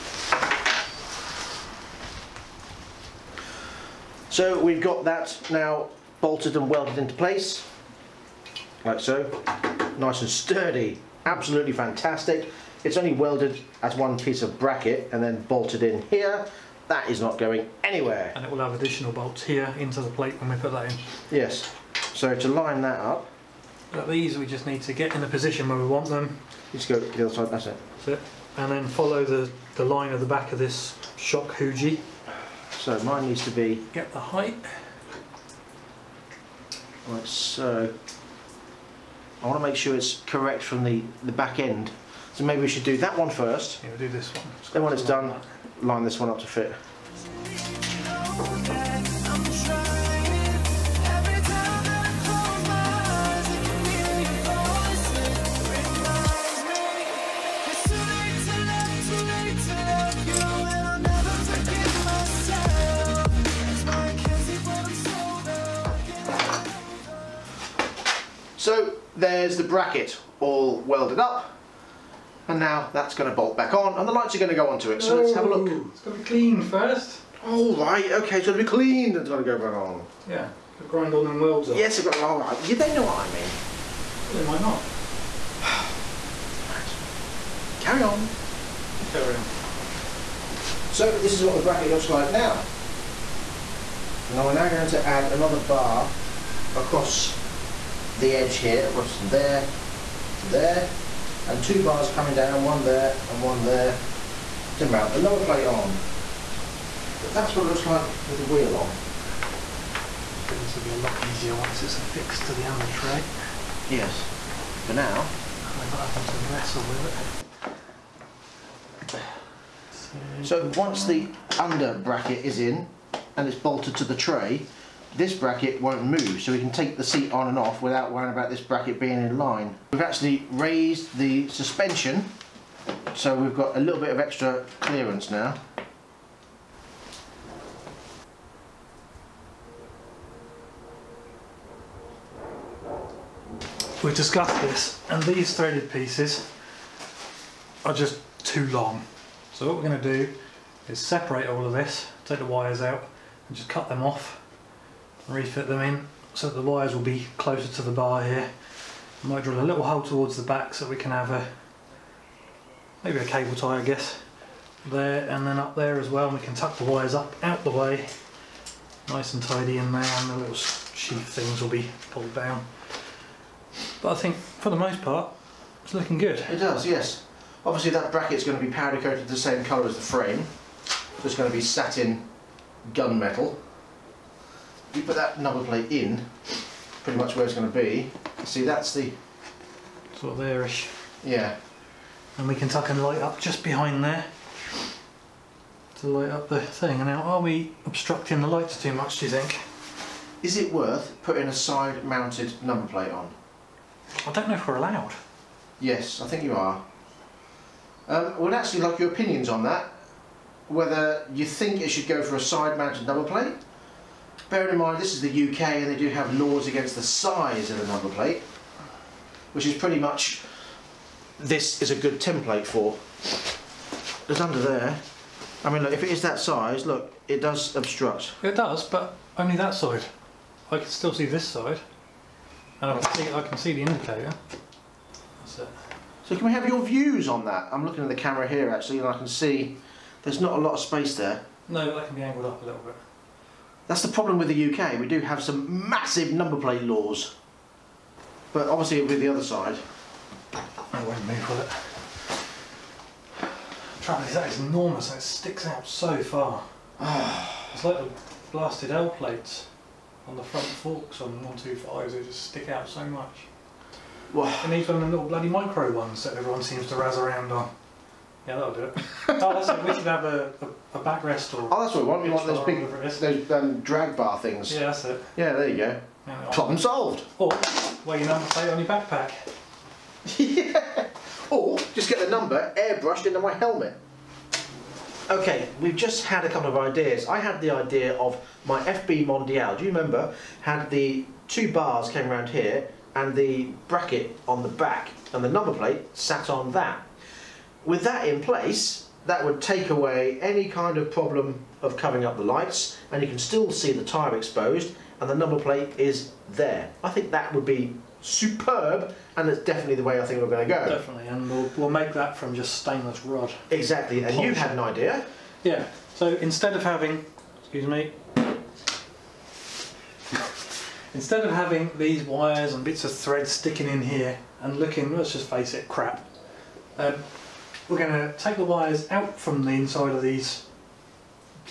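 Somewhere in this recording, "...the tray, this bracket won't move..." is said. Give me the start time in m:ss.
2:04.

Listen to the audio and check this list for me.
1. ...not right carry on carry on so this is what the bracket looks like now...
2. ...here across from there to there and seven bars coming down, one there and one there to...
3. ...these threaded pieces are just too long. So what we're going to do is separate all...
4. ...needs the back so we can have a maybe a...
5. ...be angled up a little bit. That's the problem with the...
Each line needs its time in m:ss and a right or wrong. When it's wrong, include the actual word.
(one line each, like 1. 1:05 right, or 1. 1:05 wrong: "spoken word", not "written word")
1. 1:24 right
2. 1:38 wrong: "two", not "seven"
3. 2:25 right
4. 2:40 wrong: "towards", not "needs"
5. 4:02 right.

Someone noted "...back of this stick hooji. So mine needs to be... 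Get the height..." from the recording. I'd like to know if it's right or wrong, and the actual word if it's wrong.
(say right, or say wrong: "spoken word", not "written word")
wrong: "shock", not "stick".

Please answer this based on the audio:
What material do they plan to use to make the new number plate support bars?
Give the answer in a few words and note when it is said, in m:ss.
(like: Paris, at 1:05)
Stainless rod, at 5:12.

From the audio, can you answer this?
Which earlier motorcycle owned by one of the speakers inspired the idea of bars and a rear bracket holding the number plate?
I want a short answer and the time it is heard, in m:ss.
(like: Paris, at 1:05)
FB Mondial, at 4:48.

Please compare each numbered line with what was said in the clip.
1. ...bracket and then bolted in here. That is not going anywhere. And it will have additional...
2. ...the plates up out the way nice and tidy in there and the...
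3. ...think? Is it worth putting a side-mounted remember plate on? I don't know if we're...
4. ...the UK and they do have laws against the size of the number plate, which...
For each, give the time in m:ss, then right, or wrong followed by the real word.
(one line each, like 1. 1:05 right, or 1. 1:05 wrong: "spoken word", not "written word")
1. 0:14 right
2. 2:46 wrong: "wires", not "plates"
3. 3:19 wrong: "number", not "remember"
4. 3:35 right.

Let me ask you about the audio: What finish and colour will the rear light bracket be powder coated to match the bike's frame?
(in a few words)
Satin gunmetal.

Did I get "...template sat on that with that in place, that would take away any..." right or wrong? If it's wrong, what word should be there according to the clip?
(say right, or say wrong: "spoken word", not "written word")
wrong: "plate", not "template".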